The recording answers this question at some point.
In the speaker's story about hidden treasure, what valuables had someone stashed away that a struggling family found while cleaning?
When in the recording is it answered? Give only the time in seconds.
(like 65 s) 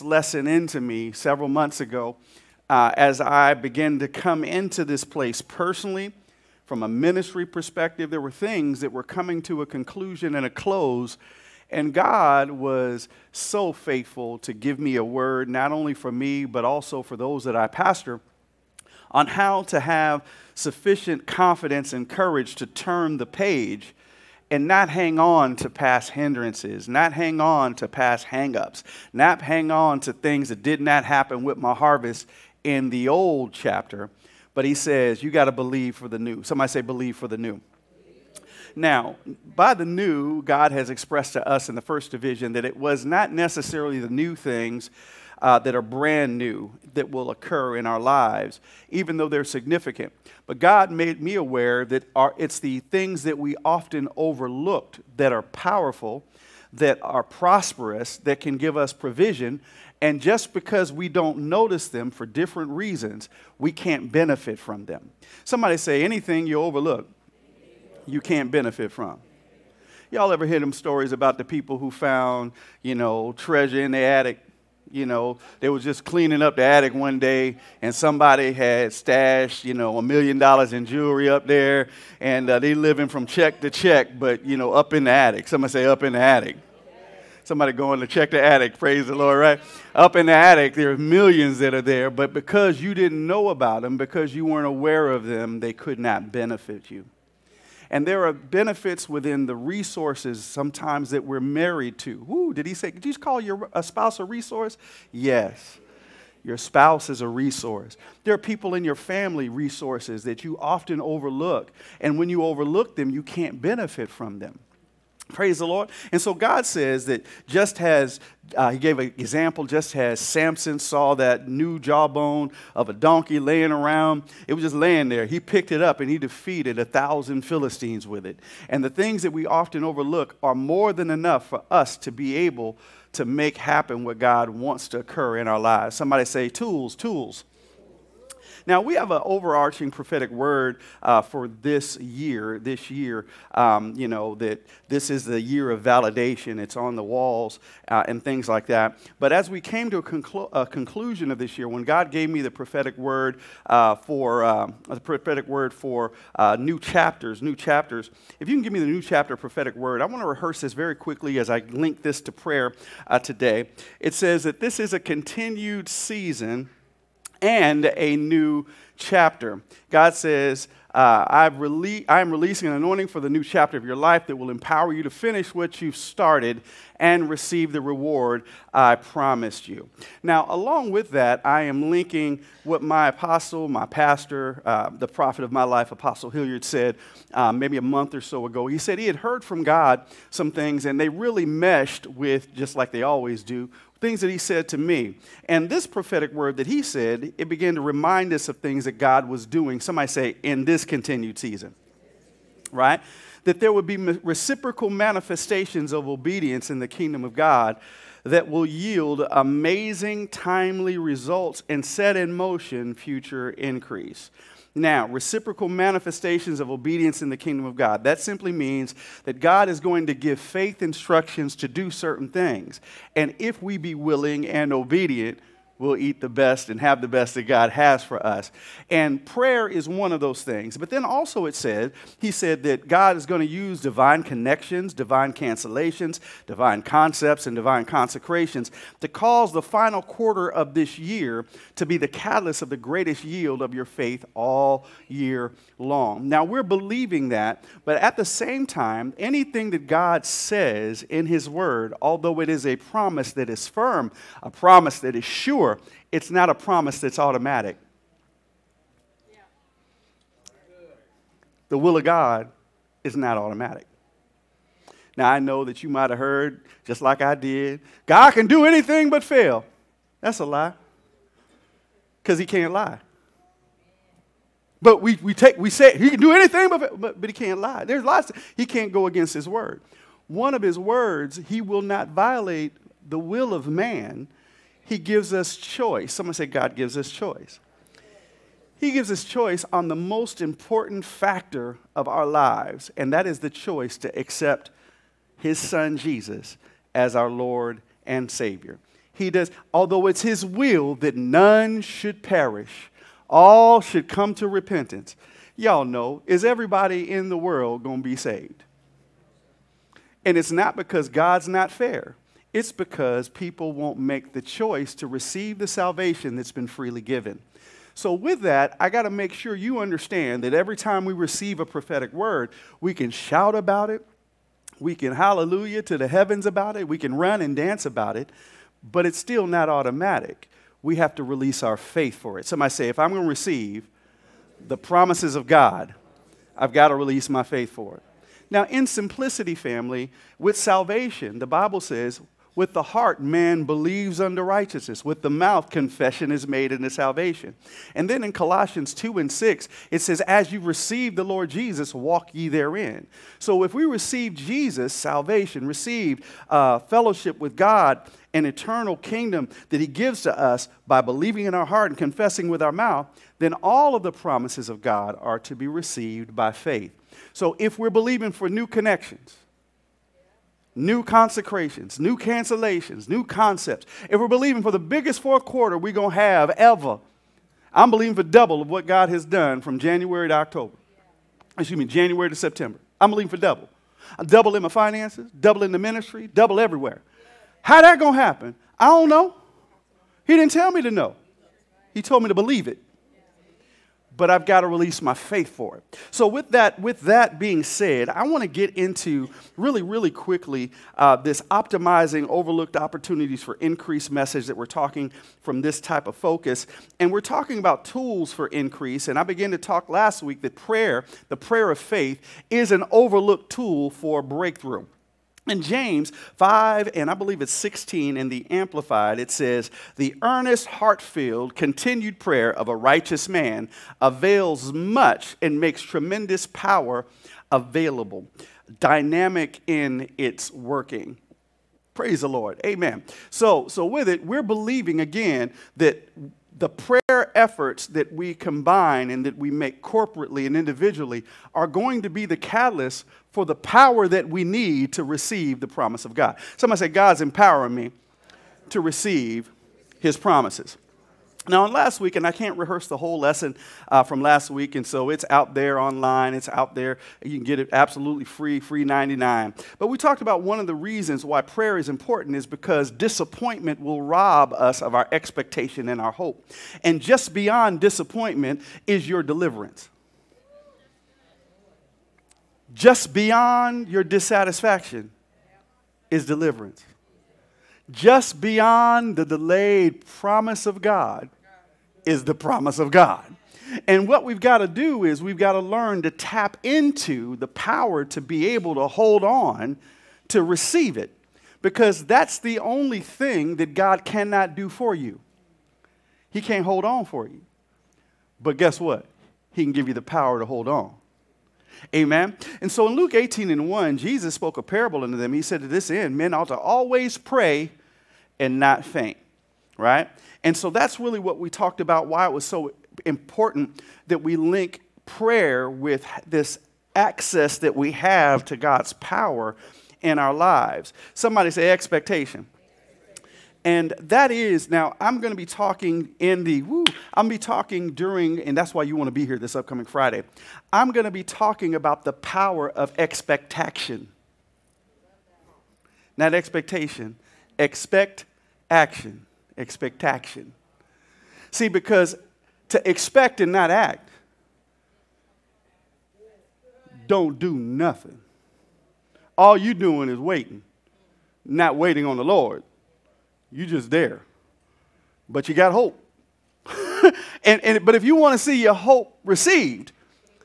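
79 s.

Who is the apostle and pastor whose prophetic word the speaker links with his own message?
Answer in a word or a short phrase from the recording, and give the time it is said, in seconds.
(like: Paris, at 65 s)
Apostle Hilliard, at 185 s.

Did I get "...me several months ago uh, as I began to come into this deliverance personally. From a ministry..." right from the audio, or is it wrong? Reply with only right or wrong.
wrong.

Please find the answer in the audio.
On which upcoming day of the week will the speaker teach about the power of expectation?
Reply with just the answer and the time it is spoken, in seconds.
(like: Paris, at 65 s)
Friday, at 529 s.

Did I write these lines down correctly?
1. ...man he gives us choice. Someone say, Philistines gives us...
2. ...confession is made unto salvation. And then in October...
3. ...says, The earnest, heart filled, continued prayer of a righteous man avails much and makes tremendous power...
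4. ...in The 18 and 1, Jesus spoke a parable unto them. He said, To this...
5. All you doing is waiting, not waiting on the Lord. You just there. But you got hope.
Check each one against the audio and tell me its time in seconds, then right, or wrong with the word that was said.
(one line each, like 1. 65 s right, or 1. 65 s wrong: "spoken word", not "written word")
1. 283 s wrong: "God", not "Philistines"
2. 345 s wrong: "Colossians", not "October"
3. 419 s right
4. 502 s wrong: "Luke", not "The"
5. 549 s right.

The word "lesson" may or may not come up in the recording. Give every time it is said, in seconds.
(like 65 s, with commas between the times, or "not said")
0 s, 453 s.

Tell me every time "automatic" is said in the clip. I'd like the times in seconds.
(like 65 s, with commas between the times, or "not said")
257 s, 263 s, 329 s.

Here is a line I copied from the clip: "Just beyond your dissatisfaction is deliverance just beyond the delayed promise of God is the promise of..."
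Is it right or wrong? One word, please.
right.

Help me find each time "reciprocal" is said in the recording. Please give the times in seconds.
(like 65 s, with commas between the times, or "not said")
203 s, 215 s.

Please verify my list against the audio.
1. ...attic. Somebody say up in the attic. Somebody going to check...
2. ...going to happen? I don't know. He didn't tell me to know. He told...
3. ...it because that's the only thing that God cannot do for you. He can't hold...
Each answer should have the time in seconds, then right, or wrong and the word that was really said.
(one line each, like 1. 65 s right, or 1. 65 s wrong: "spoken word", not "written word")
1. 85 s right
2. 387 s right
3. 490 s right.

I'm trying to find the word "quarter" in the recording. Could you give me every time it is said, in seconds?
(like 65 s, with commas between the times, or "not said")
240 s, 375 s.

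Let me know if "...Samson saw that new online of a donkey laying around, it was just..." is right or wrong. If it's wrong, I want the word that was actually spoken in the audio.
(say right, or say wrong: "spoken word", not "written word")
wrong: "jawbone", not "online".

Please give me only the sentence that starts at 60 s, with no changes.
And just because we don't notice them for different reasons, we can't benefit from them.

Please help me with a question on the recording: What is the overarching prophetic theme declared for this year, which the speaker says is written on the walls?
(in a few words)
The year of validation.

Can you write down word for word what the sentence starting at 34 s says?
But he says, you got to believe for the new.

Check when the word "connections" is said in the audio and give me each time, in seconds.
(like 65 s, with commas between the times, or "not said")
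234 s, 368 s.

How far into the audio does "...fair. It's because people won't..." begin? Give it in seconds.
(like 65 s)
311 s.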